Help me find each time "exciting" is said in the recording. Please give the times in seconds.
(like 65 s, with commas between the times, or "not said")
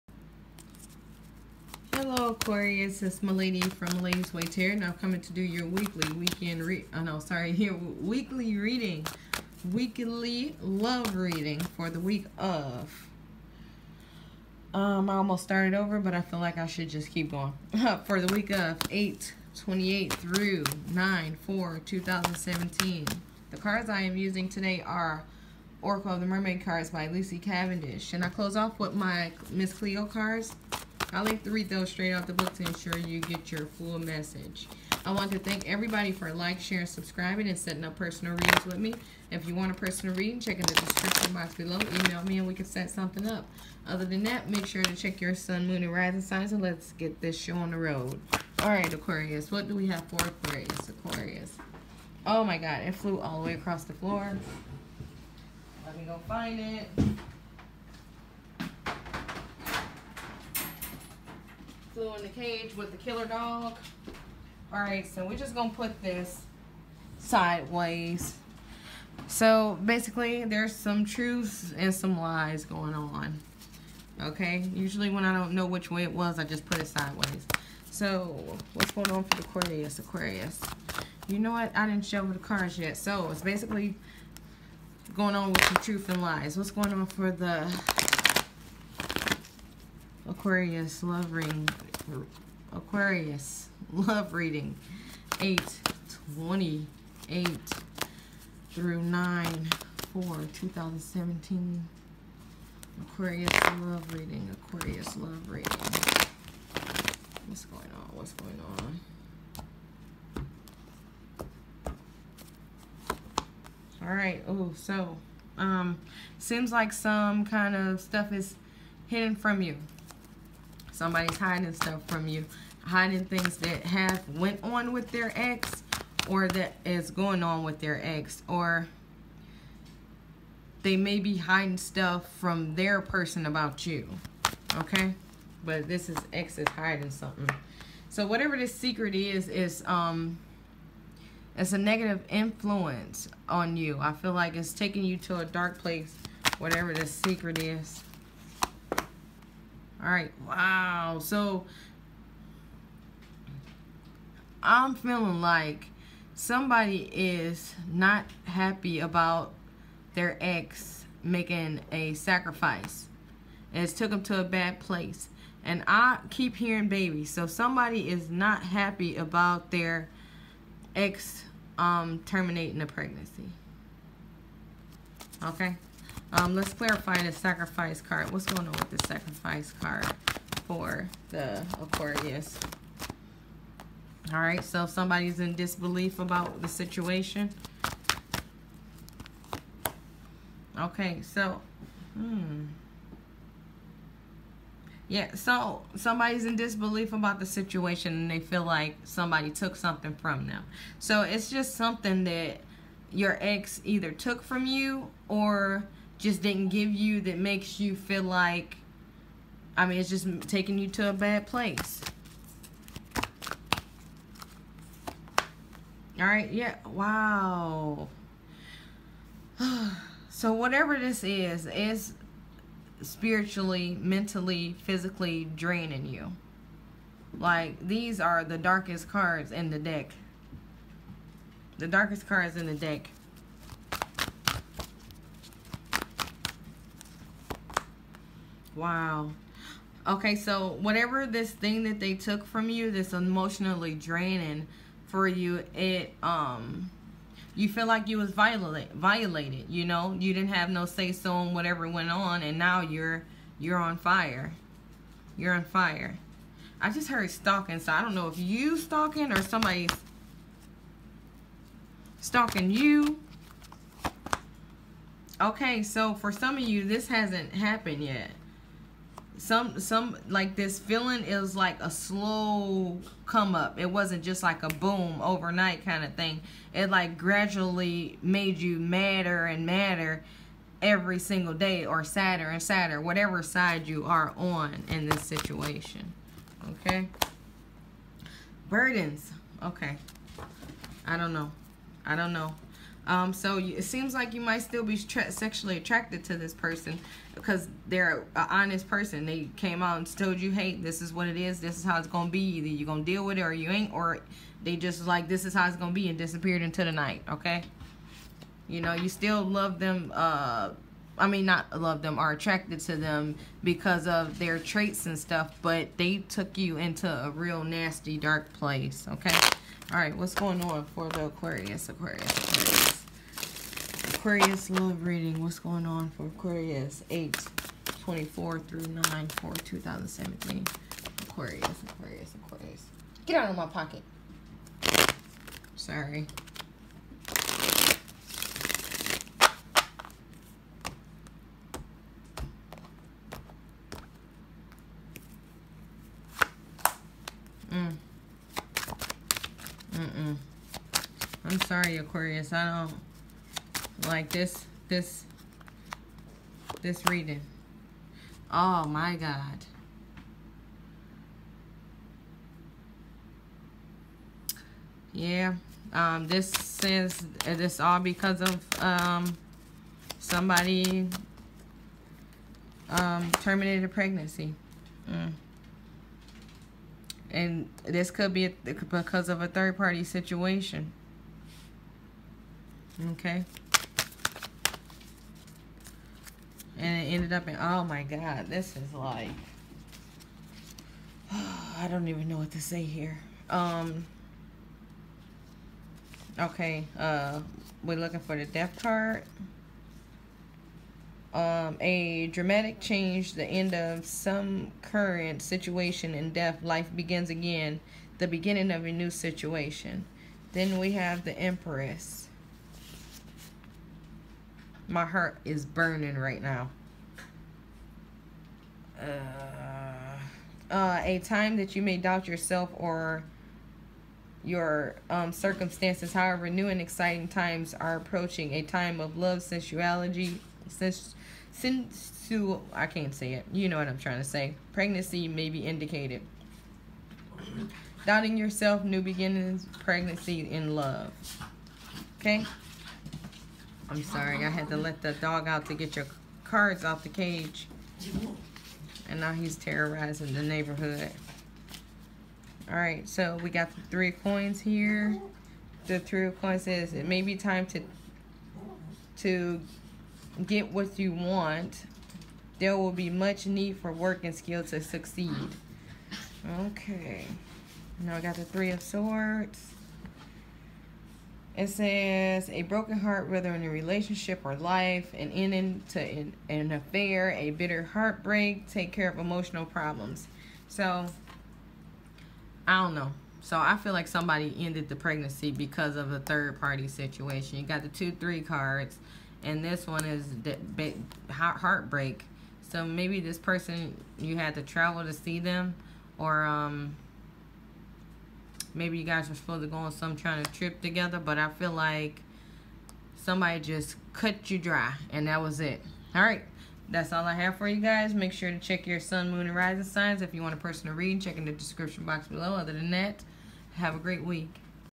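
426 s.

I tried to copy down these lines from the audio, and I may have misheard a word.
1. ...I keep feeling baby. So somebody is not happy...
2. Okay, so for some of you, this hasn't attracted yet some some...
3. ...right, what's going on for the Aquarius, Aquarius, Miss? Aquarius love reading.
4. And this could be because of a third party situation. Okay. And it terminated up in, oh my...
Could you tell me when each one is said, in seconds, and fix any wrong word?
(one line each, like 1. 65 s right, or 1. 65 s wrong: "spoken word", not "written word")
1. 165 s wrong: "hearing", not "feeling"
2. 265 s wrong: "happened", not "attracted"
3. 319 s wrong: "Aquarius", not "Miss"
4. 377 s wrong: "ended", not "terminated".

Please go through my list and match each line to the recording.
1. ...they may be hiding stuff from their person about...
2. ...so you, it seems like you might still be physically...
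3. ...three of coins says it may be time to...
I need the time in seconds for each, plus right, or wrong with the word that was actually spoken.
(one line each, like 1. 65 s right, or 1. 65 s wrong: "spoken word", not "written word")
1. 130 s right
2. 293 s wrong: "sexually", not "physically"
3. 455 s right.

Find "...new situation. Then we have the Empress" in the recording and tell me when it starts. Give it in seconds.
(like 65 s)
408 s.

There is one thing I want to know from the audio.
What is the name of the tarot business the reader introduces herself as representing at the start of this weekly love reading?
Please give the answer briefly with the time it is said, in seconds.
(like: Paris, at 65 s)
Malady's Way Tarot, at 3 s.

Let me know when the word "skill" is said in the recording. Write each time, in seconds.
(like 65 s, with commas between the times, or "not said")
464 s.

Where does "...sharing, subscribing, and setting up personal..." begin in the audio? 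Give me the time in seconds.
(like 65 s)
36 s.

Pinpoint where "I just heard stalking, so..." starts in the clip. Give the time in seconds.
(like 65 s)
256 s.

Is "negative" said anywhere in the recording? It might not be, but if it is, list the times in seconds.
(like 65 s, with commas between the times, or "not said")
141 s.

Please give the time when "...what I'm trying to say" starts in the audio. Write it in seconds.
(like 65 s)
433 s.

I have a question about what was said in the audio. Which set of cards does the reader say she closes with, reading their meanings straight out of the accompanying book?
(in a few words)
Miss Cleo cards.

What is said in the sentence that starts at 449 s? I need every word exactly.
And now he's terrorizing the neighborhood.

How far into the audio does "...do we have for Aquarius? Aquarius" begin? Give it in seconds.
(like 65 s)
49 s.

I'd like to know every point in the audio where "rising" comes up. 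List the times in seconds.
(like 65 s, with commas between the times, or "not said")
45 s, 509 s.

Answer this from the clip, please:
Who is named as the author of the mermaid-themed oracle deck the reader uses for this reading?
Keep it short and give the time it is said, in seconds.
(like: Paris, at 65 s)
Lucy Cavendish, at 27 s.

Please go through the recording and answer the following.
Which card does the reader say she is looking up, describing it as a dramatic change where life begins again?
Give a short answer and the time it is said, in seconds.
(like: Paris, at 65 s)
The death card, at 398 s.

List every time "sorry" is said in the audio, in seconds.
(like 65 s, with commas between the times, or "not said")
7 s, 335 s, 351 s, 444 s.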